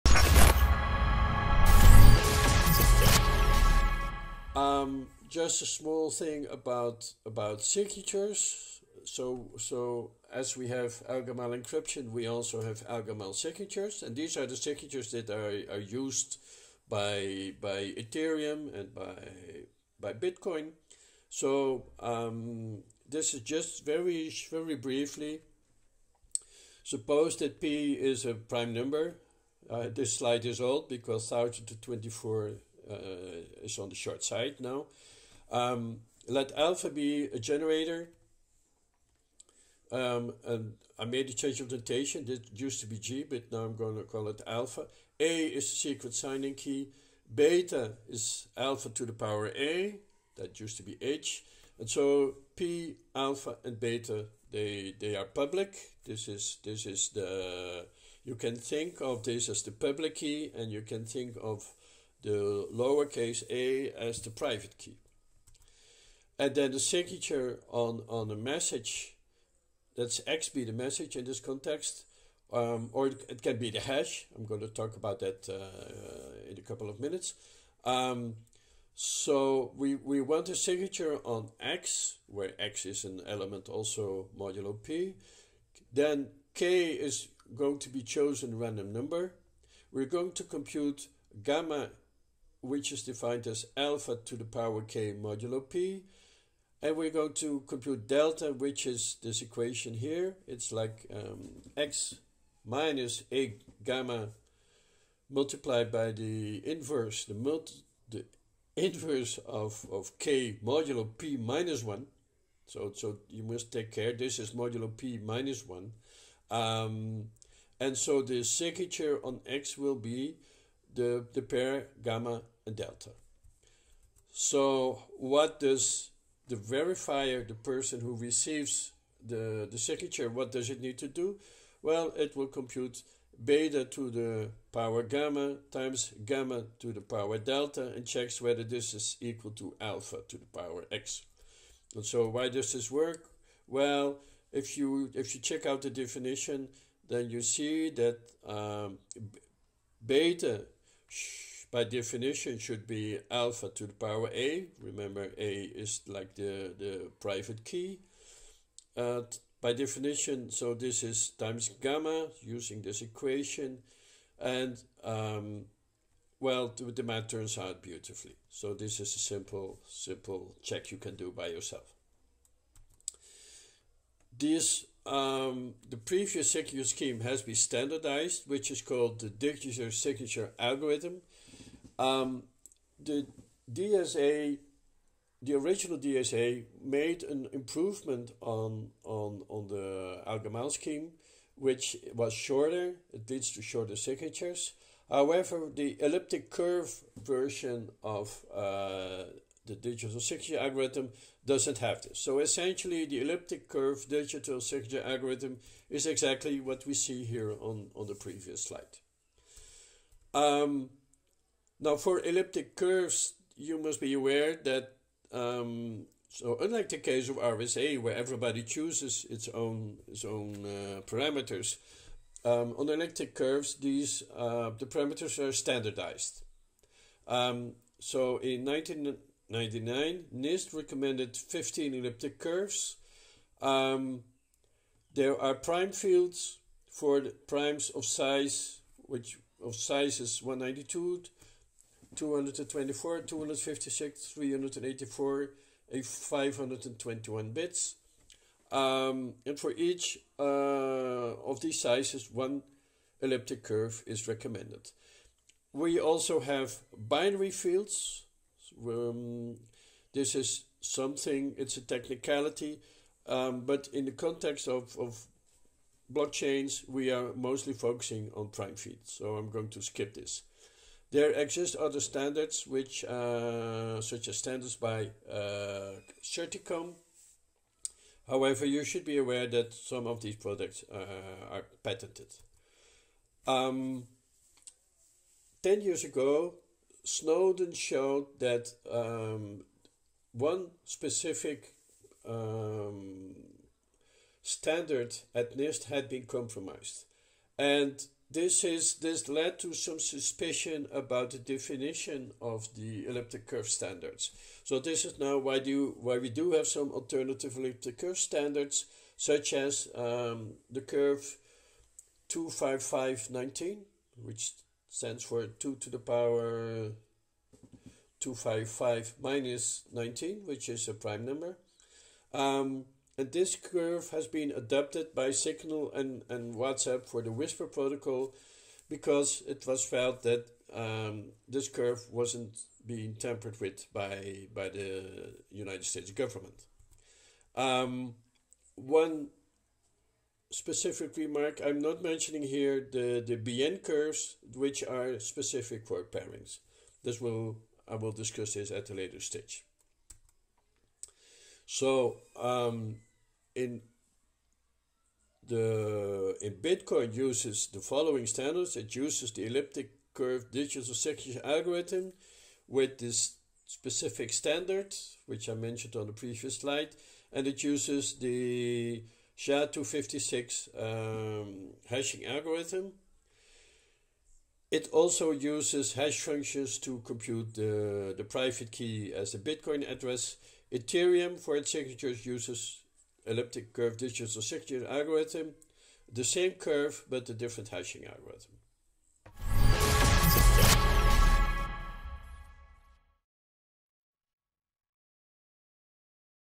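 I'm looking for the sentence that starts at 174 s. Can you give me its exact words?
This um, the previous signature scheme has been standardized, which is called the digital signature algorithm.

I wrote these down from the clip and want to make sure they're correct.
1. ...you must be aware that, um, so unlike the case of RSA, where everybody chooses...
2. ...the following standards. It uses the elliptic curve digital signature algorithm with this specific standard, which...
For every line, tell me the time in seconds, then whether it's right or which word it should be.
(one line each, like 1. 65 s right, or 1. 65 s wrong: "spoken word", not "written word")
1. 213 s right
2. 357 s right.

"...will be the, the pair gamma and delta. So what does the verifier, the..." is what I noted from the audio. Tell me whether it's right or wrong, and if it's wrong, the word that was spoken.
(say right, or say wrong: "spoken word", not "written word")
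right.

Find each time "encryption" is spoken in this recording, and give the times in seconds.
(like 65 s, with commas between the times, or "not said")
11 s.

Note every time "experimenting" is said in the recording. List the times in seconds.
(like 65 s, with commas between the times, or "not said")
not said.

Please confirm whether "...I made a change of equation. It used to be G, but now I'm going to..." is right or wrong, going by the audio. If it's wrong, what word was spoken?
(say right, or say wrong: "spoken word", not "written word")
wrong: "notation", not "equation".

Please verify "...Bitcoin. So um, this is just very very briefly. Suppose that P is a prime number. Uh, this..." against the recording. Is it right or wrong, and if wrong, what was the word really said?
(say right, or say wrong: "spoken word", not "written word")
right.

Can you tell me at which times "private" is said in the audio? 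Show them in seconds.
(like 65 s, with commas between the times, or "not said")
64 s, 157 s, 378 s.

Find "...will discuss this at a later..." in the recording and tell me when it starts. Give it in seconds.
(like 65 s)
347 s.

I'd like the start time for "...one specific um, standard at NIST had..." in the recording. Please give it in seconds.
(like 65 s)
290 s.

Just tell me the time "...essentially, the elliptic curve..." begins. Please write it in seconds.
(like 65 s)
202 s.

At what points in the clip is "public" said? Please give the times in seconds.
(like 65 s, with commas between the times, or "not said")
55 s, 59 s.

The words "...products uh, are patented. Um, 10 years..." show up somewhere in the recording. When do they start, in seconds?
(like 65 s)
280 s.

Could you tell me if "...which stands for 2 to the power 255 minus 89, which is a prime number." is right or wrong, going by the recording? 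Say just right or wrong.
wrong.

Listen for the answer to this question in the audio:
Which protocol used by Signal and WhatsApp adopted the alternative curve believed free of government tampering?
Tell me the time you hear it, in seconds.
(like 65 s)
327 s.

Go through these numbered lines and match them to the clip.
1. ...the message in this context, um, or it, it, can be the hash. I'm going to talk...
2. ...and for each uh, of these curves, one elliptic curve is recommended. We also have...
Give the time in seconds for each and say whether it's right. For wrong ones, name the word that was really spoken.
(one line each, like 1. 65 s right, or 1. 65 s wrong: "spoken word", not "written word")
1. 70 s right
2. 249 s wrong: "sizes", not "curves".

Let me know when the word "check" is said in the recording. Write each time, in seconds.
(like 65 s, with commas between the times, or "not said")
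138 s, 145 s, 170 s.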